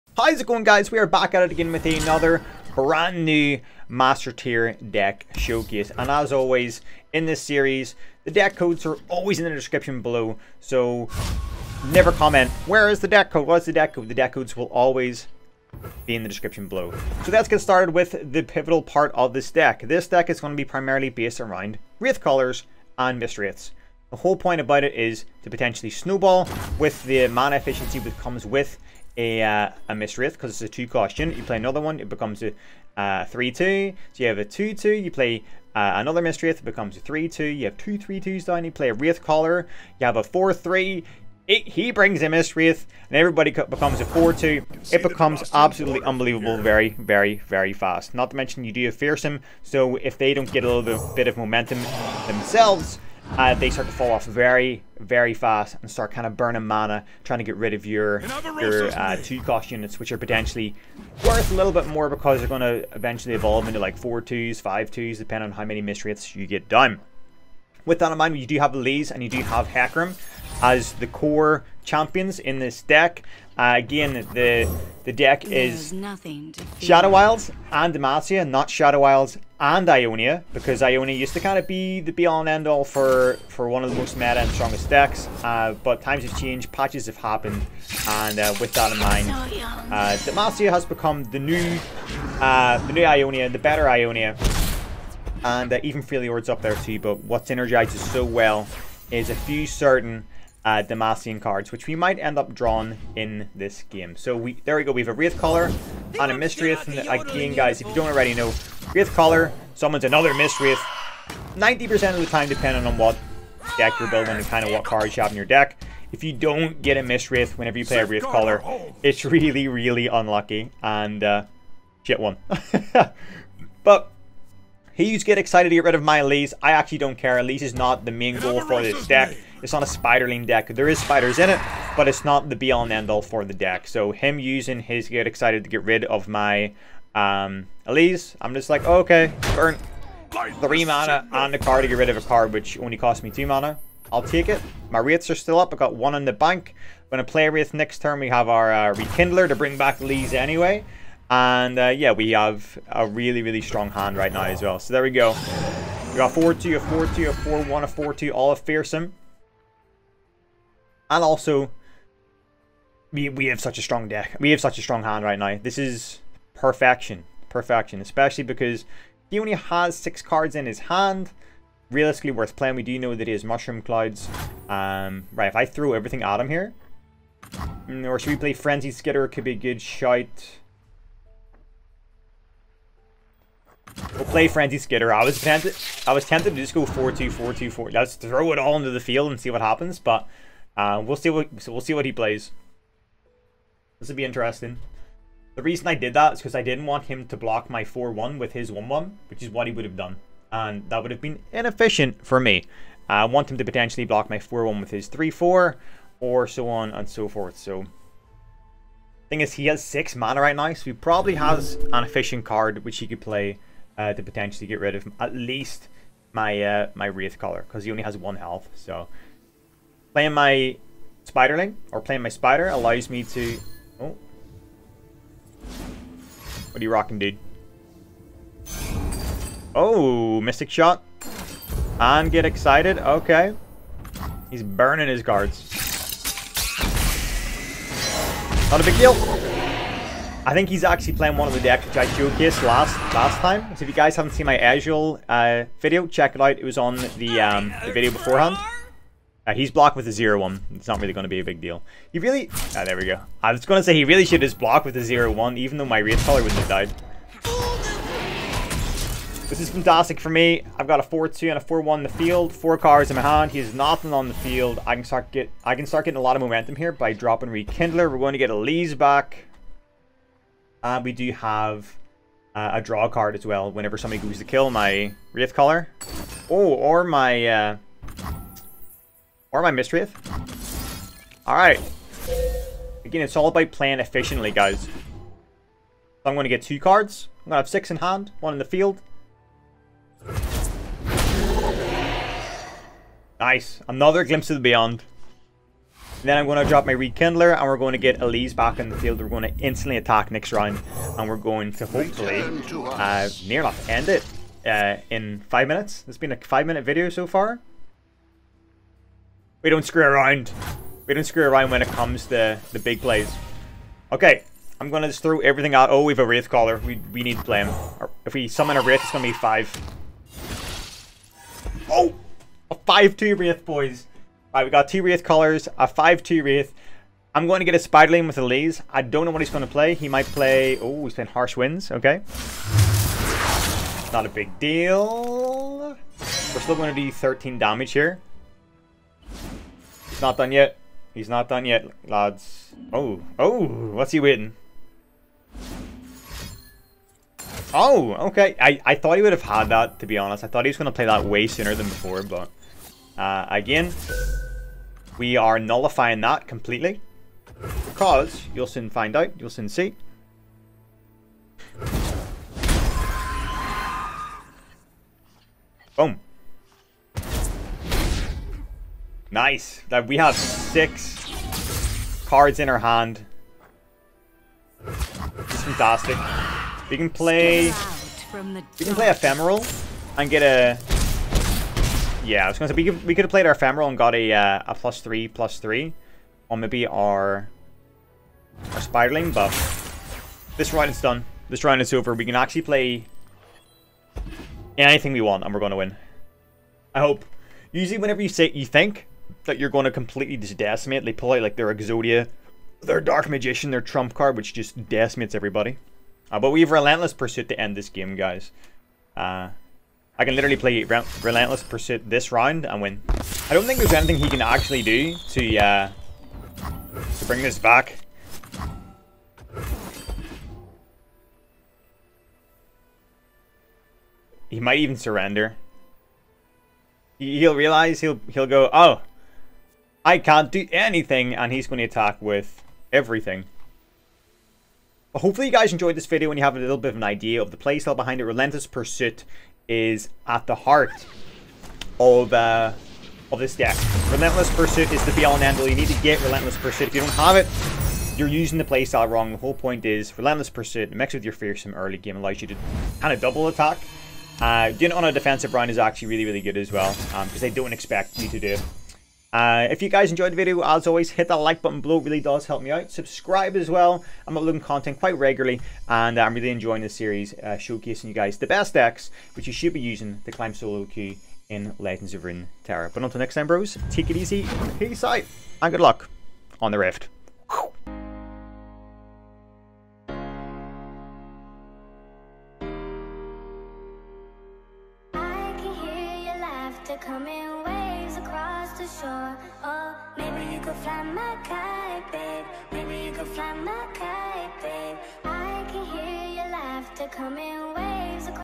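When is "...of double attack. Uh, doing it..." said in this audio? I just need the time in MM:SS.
07:33.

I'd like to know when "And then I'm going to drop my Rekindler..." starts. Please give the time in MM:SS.
04:56.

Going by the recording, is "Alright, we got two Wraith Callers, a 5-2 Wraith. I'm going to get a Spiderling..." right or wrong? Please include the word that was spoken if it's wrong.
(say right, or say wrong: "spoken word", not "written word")
right.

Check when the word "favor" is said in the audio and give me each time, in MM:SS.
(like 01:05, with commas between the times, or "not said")
not said.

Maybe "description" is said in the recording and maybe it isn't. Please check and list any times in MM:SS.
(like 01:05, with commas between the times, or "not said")
00:09, 00:16.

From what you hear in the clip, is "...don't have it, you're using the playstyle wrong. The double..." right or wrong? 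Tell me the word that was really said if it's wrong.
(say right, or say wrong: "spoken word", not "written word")
wrong: "whole", not "double".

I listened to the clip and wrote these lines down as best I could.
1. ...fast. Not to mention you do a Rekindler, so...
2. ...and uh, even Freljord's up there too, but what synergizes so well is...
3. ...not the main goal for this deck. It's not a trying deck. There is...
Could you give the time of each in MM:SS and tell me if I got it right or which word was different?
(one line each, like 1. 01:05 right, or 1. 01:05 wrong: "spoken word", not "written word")
1. 00:47 wrong: "Fearsome", not "Rekindler"
2. 01:35 right
3. 02:07 wrong: "spiderling", not "trying".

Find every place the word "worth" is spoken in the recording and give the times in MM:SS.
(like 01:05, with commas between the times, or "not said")
01:01, 02:52.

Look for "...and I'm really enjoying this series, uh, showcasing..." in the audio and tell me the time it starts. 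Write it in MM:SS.
07:45.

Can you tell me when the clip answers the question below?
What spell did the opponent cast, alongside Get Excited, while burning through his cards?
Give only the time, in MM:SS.
03:50.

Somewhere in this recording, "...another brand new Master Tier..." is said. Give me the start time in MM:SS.
00:01.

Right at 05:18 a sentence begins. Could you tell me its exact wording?
If we summon a Wraith, it's gonna be five.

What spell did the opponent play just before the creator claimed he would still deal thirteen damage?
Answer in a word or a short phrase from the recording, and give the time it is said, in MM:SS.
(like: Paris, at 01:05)
Harsh Winds, at 05:31.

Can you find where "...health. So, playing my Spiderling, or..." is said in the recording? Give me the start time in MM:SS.
03:38.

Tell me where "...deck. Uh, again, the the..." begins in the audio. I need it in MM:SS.
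01:12.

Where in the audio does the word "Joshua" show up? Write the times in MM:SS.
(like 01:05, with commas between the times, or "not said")
not said.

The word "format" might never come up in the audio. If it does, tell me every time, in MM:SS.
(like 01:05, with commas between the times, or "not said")
not said.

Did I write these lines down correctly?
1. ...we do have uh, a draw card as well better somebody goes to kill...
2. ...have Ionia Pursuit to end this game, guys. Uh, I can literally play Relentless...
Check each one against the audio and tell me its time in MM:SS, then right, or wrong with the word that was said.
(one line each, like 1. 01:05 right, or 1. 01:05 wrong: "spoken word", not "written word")
1. 04:31 wrong: "whenever", not "better"
2. 06:46 wrong: "Relentless", not "Ionia".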